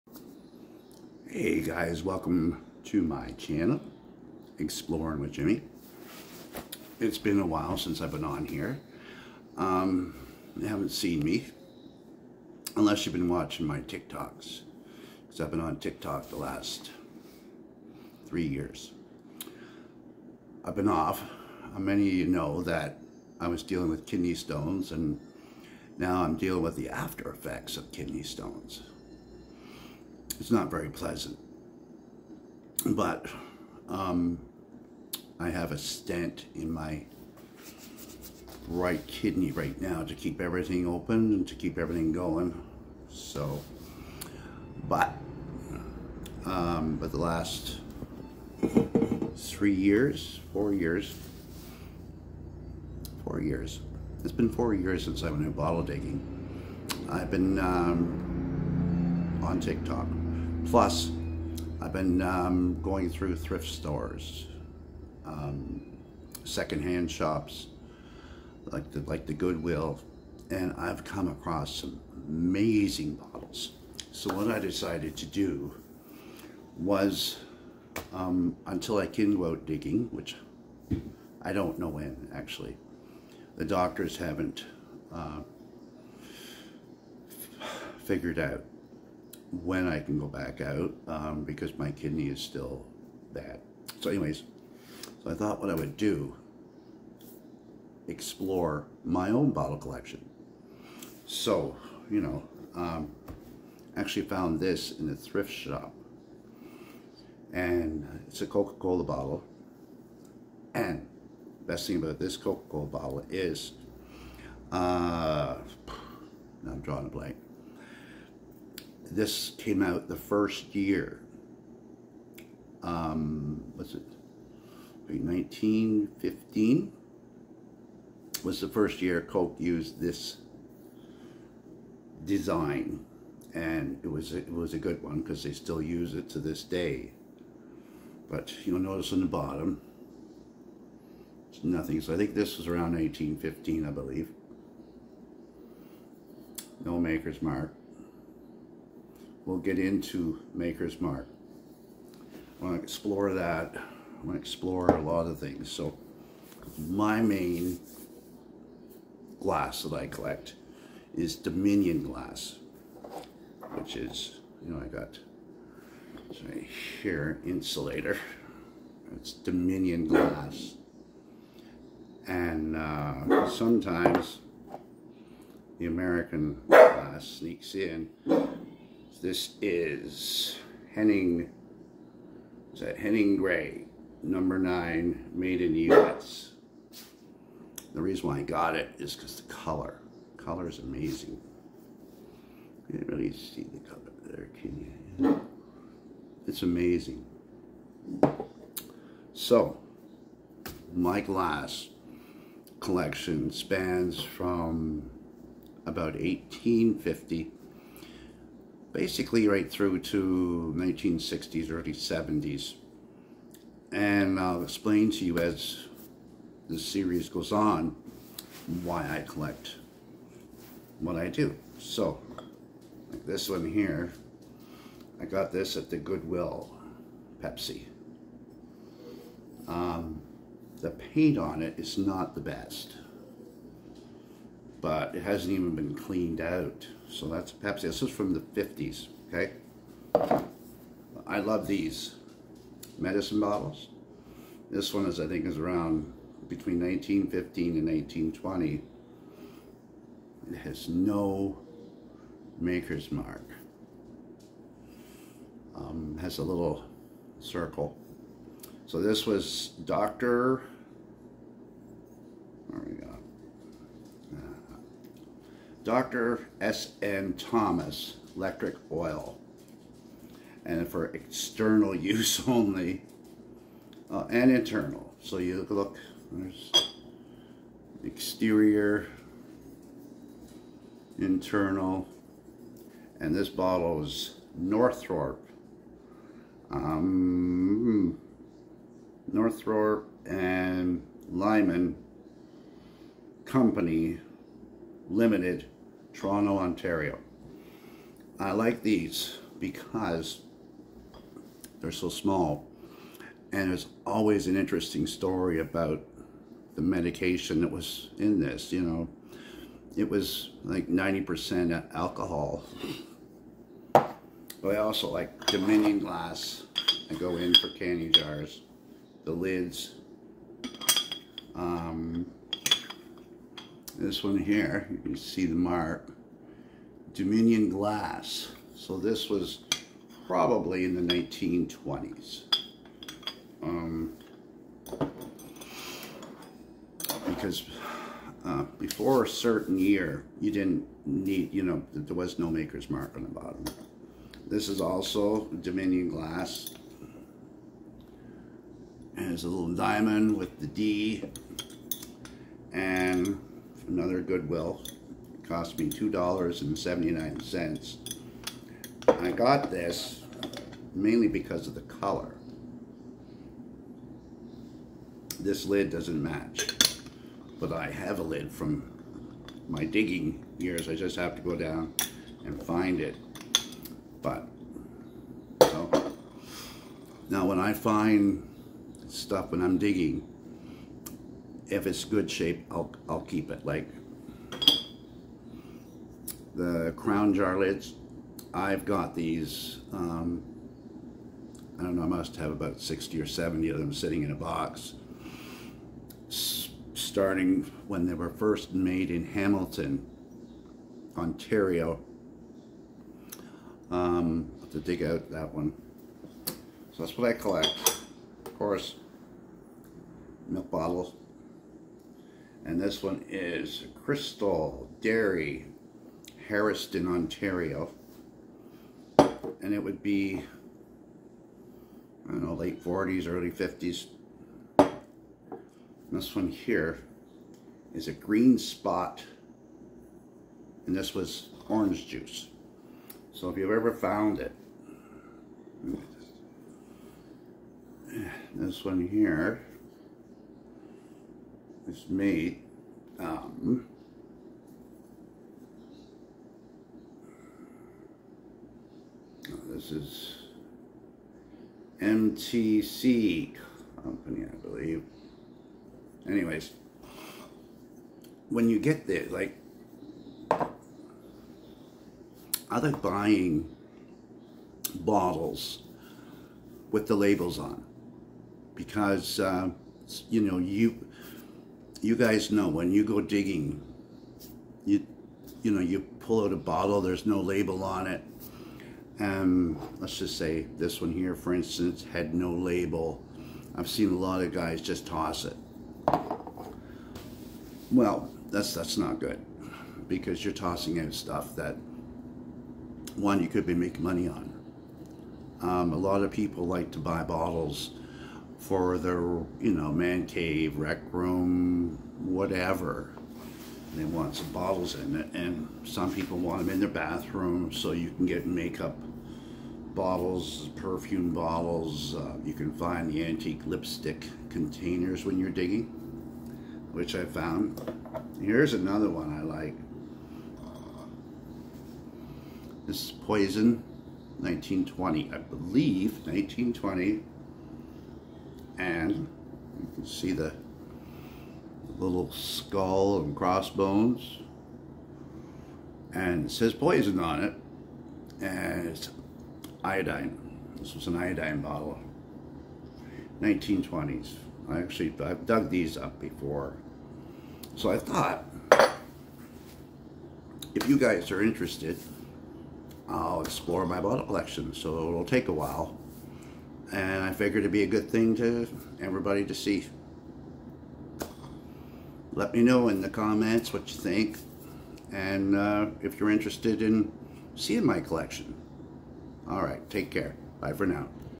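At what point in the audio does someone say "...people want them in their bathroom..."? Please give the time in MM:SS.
08:26.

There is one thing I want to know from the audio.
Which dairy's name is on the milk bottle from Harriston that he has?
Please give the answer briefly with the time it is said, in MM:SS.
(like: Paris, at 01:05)
Crystal Dairy, at 06:54.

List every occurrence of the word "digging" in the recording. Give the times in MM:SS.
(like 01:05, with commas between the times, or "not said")
00:55, 01:19, 06:09, 06:19, 07:53, 08:35.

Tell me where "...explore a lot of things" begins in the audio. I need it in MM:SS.
02:34.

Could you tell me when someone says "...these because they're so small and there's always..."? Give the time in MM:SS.
04:58.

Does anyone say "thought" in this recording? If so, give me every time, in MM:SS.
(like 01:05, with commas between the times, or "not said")
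01:35, 09:07.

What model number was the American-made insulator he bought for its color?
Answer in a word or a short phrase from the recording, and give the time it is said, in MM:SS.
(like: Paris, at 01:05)
9, at 03:04.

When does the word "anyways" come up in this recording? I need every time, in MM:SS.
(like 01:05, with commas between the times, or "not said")
01:34, 07:36.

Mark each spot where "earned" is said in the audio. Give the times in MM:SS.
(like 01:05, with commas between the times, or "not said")
not said.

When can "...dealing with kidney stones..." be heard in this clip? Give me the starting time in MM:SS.
00:23.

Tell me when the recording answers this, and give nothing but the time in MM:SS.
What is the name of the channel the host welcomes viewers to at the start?
00:04.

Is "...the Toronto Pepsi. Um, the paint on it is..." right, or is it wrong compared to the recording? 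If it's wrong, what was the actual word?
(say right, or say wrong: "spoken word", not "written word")
wrong: "Goodwill", not "Toronto".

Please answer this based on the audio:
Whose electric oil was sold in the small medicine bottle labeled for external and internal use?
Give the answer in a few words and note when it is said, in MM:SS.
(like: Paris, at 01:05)
Dr. S.N. Thomas, at 04:25.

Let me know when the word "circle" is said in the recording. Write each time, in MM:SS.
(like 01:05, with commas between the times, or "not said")
04:17.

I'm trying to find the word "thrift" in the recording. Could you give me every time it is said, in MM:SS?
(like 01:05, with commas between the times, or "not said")
01:03, 01:45.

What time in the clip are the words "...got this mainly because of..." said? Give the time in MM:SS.
05:59.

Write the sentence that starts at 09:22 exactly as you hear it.
Let me know in the comments what you think and uh, if you're interested in seeing my collection.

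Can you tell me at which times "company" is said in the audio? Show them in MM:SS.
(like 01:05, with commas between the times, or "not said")
04:53, 07:34.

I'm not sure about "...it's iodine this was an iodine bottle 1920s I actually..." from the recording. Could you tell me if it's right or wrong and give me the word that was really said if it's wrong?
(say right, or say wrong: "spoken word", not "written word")
right.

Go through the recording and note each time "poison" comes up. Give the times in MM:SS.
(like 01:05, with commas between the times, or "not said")
08:43, 08:56.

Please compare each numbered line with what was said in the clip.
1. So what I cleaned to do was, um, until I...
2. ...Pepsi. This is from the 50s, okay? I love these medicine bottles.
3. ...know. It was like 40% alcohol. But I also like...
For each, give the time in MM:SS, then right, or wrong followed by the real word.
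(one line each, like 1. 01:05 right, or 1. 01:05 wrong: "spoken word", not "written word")
1. 01:14 wrong: "decided", not "cleaned"
2. 03:57 right
3. 05:08 wrong: "90", not "40".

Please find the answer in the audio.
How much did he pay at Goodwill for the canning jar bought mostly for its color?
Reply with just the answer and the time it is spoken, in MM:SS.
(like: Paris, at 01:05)
$2.79, at 05:55.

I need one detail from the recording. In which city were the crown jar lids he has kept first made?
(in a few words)
Hamilton, Ontario.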